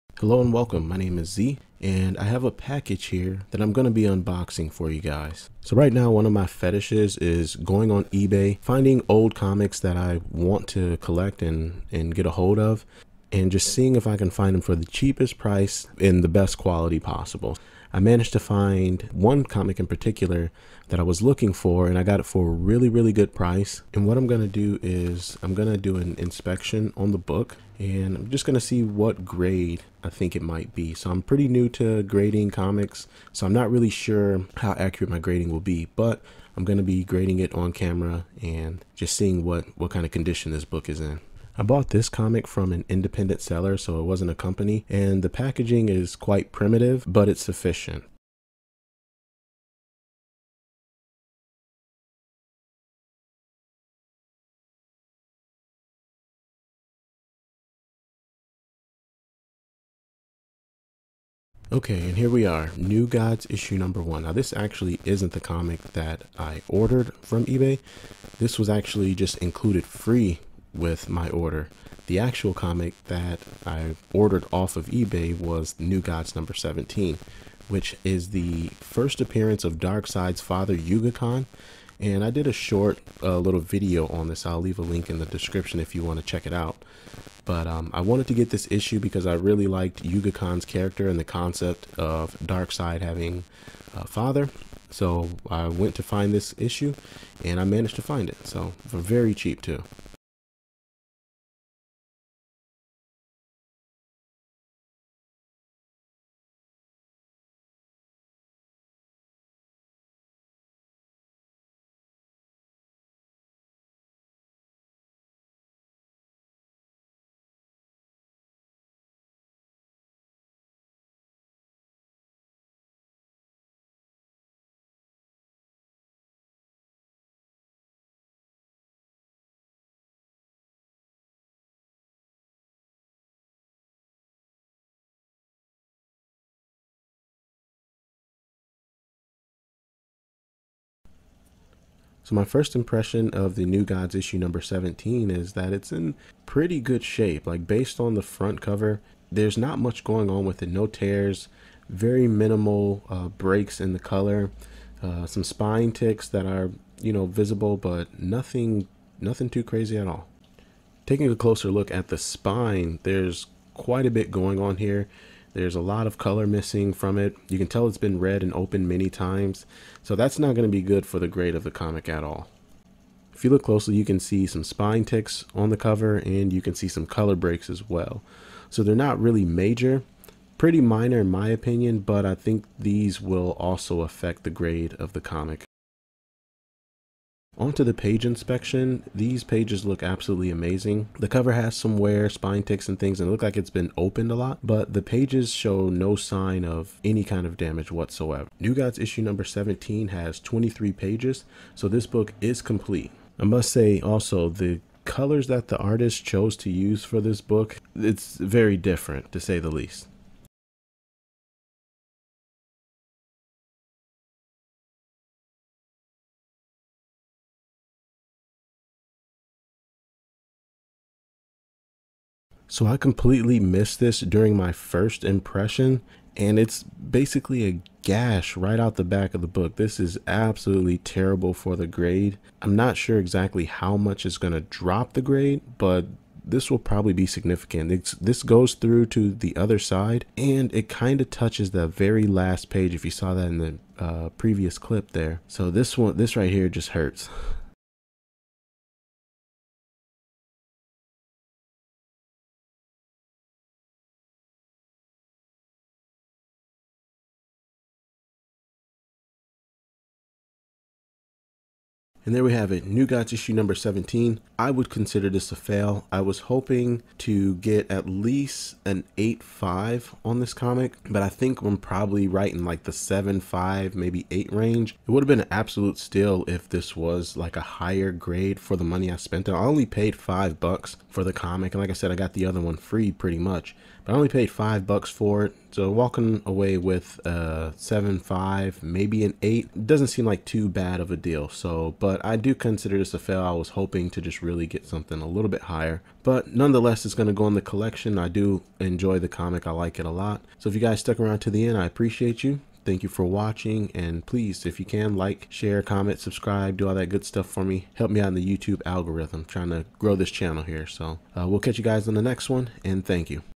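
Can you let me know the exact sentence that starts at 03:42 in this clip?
So I completely missed this during my first impression, and it's basically a gash right out the back of the book.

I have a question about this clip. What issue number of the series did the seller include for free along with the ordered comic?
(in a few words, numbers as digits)
1.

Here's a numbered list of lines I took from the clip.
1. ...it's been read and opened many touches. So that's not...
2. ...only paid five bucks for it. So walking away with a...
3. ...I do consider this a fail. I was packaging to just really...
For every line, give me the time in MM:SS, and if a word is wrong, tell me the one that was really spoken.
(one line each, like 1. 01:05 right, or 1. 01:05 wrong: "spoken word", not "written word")
1. 02:47 wrong: "times", not "touches"
2. 04:44 right
3. 04:52 wrong: "hoping", not "packaging".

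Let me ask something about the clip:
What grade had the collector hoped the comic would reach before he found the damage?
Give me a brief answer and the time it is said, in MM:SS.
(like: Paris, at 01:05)
8.5, at 04:29.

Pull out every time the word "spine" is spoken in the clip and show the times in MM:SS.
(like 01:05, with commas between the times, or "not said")
02:35, 02:42, 02:54, 03:12.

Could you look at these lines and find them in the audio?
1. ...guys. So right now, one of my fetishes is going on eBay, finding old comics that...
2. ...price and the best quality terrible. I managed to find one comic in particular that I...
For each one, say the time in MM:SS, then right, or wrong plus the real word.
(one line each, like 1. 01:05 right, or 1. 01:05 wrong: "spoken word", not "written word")
1. 00:05 right
2. 00:15 wrong: "possible", not "terrible".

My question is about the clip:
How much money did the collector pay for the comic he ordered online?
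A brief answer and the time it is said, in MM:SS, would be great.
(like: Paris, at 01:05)
$5, at 04:40.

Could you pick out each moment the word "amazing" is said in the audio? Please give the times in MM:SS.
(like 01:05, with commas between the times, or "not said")
03:10.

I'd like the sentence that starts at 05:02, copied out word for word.
Thank you for watching and please, if you can, like, share, comment, subscribe, do all that good stuff for me.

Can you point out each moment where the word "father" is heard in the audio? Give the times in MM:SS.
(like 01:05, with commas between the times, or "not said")
01:20, 01:34.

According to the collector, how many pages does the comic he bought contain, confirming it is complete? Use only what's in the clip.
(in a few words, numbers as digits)
23.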